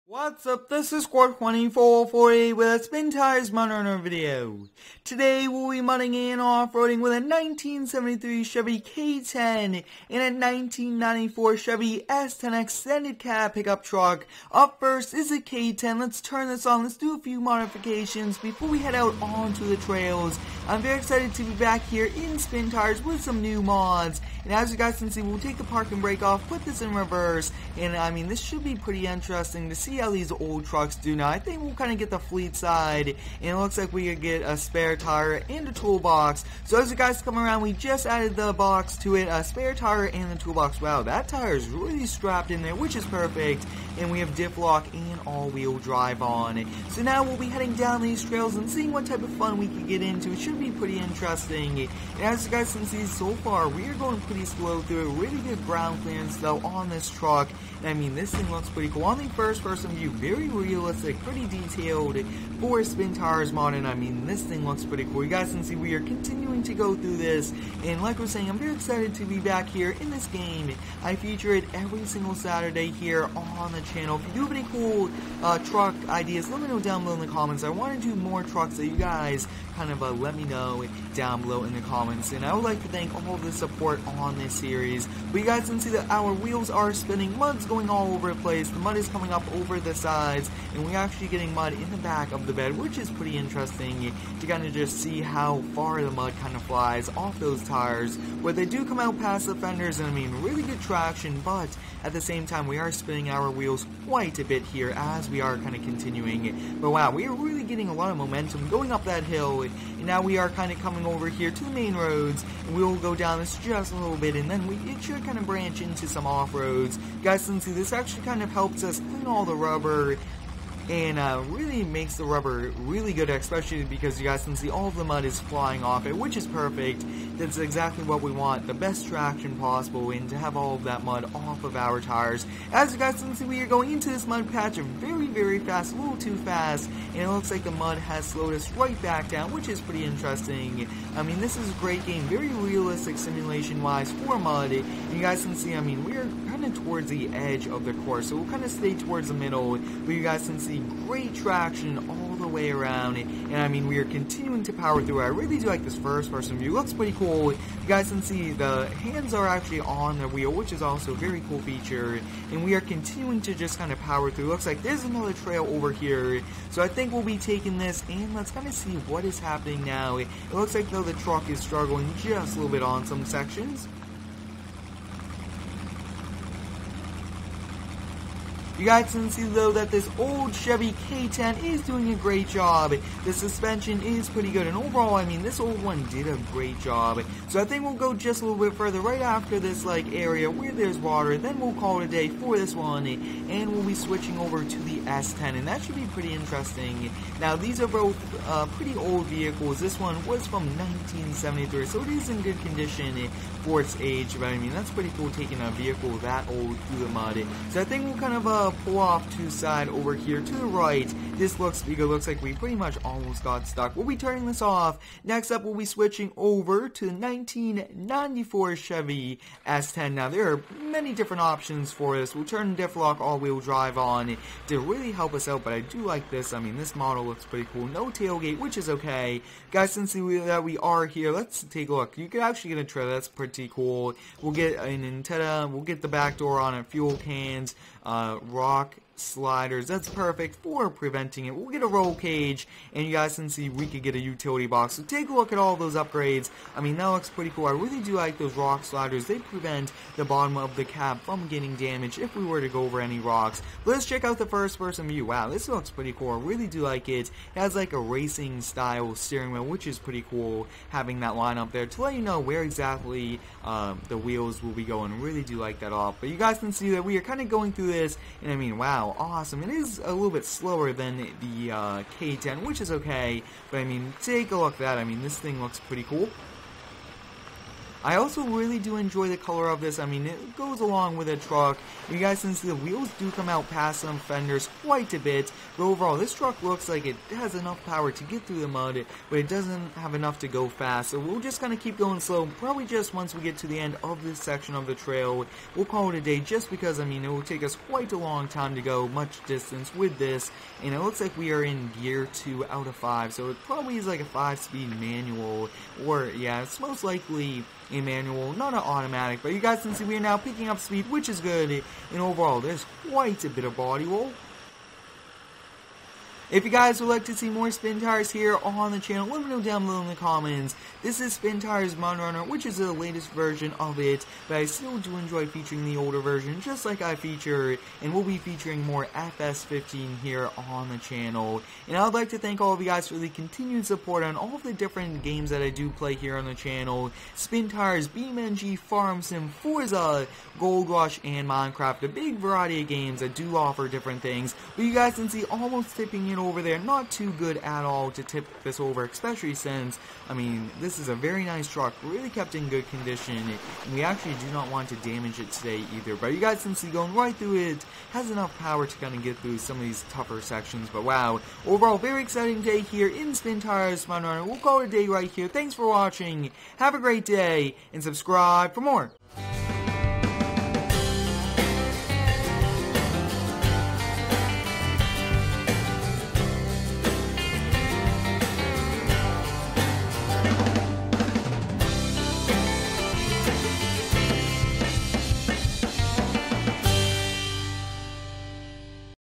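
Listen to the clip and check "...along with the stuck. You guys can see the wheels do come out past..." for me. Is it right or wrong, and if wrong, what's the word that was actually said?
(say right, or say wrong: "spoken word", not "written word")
wrong: "truck", not "stuck".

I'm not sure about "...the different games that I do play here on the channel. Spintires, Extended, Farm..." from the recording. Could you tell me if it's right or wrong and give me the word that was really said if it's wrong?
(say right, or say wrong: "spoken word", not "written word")
wrong: "BeamNG", not "Extended".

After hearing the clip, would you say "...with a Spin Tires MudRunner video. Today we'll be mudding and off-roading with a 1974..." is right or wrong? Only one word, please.
wrong.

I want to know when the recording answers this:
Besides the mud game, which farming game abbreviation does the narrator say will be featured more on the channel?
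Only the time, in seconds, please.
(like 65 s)
329 s.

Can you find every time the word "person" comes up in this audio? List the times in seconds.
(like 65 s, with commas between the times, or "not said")
59 s, 156 s, 254 s.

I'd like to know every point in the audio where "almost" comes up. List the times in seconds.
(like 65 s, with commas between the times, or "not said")
213 s, 345 s.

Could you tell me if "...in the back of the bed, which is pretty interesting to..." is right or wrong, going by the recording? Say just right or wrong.
right.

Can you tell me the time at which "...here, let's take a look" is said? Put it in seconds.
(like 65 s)
231 s.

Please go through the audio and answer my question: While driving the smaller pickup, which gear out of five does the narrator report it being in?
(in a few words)
2.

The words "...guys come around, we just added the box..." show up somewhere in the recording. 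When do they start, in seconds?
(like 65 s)
36 s.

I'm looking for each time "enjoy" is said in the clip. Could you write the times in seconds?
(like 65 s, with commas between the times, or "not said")
278 s, 325 s.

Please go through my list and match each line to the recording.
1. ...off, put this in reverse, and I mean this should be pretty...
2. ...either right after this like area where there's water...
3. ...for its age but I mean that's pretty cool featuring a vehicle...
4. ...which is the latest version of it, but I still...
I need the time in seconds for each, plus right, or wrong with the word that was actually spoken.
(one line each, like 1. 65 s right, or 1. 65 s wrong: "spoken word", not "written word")
1. 26 s right
2. 188 s wrong: "further", not "either"
3. 203 s wrong: "taking", not "featuring"
4. 322 s right.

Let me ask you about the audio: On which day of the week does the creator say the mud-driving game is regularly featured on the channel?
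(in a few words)
Saturday.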